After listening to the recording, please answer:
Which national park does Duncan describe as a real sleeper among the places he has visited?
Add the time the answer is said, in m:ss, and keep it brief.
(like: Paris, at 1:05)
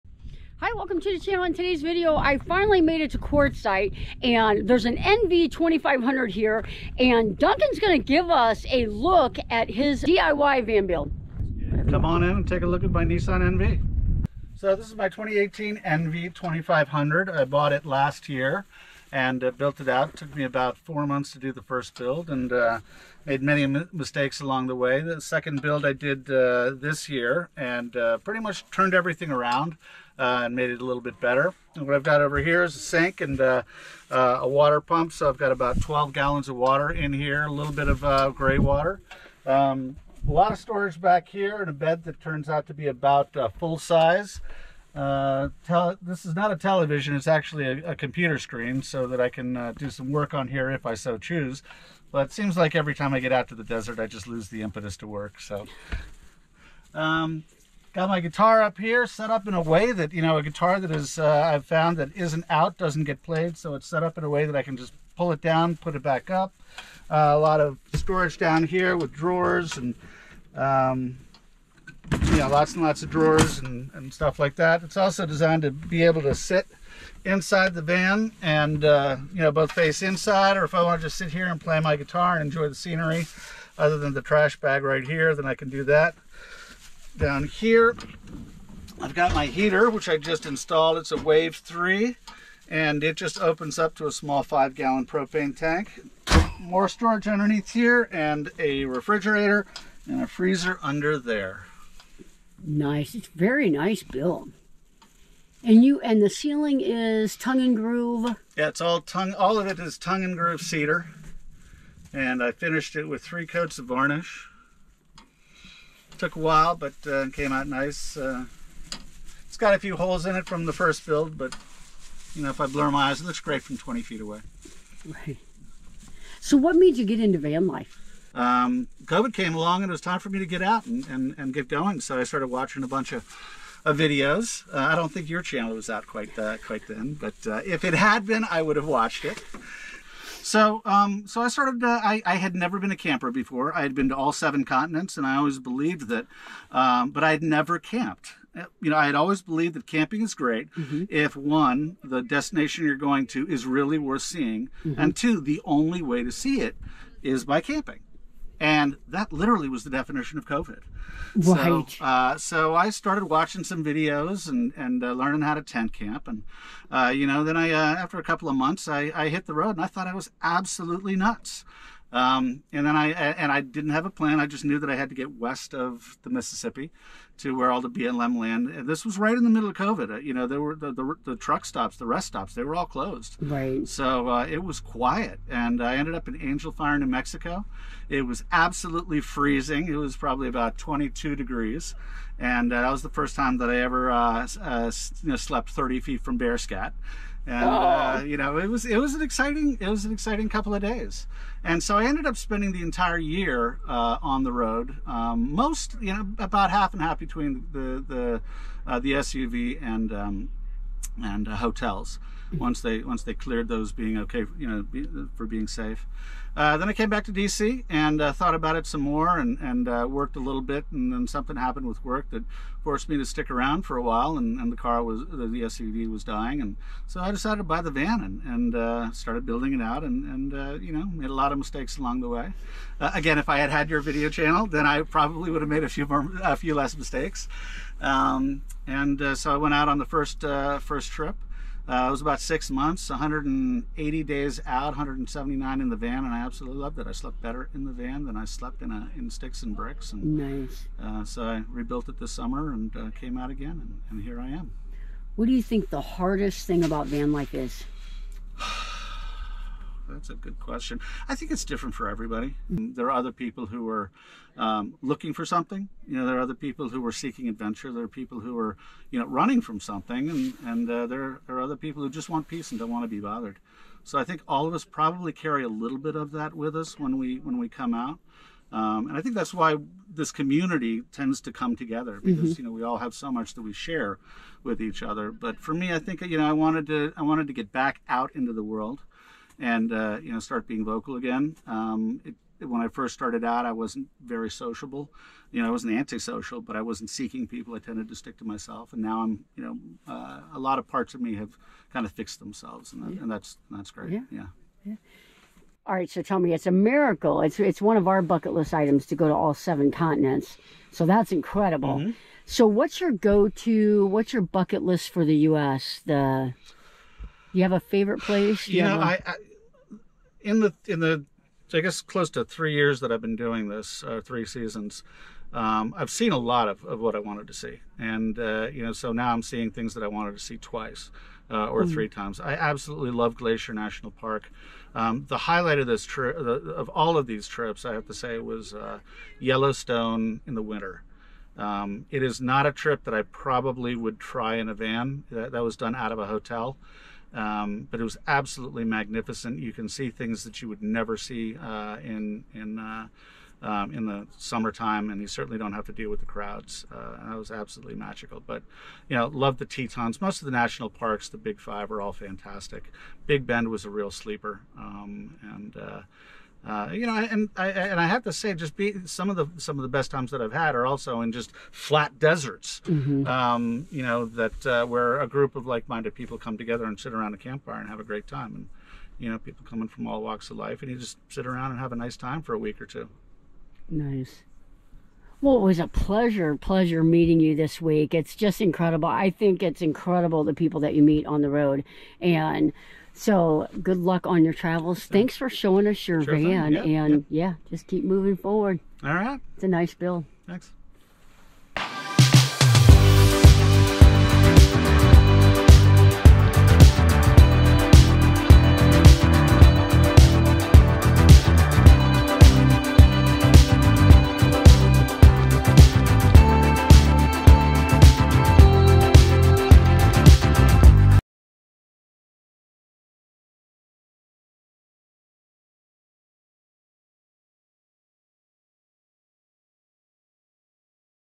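Big Bend, at 6:03.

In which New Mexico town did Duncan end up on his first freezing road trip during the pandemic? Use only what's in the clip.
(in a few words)
Angel Fire.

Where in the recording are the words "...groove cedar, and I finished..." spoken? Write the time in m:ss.
1:50.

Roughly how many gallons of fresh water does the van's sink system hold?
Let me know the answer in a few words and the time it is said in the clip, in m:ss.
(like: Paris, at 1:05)
12, at 0:35.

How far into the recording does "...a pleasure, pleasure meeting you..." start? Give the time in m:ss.
6:25.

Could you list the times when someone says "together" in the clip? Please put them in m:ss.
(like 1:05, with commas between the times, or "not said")
4:41, 6:16.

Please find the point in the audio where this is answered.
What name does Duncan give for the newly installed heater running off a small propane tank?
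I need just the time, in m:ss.
1:31.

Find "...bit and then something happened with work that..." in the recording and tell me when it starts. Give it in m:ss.
3:40.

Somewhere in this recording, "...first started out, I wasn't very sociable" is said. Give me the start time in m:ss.
4:52.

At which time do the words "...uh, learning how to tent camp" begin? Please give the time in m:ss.
2:45.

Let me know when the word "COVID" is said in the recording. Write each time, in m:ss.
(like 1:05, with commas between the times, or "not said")
2:09, 2:40, 2:59.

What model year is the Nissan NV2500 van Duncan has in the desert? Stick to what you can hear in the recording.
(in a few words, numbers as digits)
2018.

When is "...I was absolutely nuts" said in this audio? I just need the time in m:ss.
2:50.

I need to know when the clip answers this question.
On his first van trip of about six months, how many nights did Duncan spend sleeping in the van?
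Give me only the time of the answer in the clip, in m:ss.
4:04.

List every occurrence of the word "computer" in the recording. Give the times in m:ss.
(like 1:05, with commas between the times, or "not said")
0:47.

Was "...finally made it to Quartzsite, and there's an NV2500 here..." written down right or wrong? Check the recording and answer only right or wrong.
right.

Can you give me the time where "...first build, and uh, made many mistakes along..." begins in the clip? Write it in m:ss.
0:21.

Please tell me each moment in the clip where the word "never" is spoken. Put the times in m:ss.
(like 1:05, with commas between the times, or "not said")
2:22, 2:27, 5:50.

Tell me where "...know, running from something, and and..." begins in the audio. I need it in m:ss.
4:29.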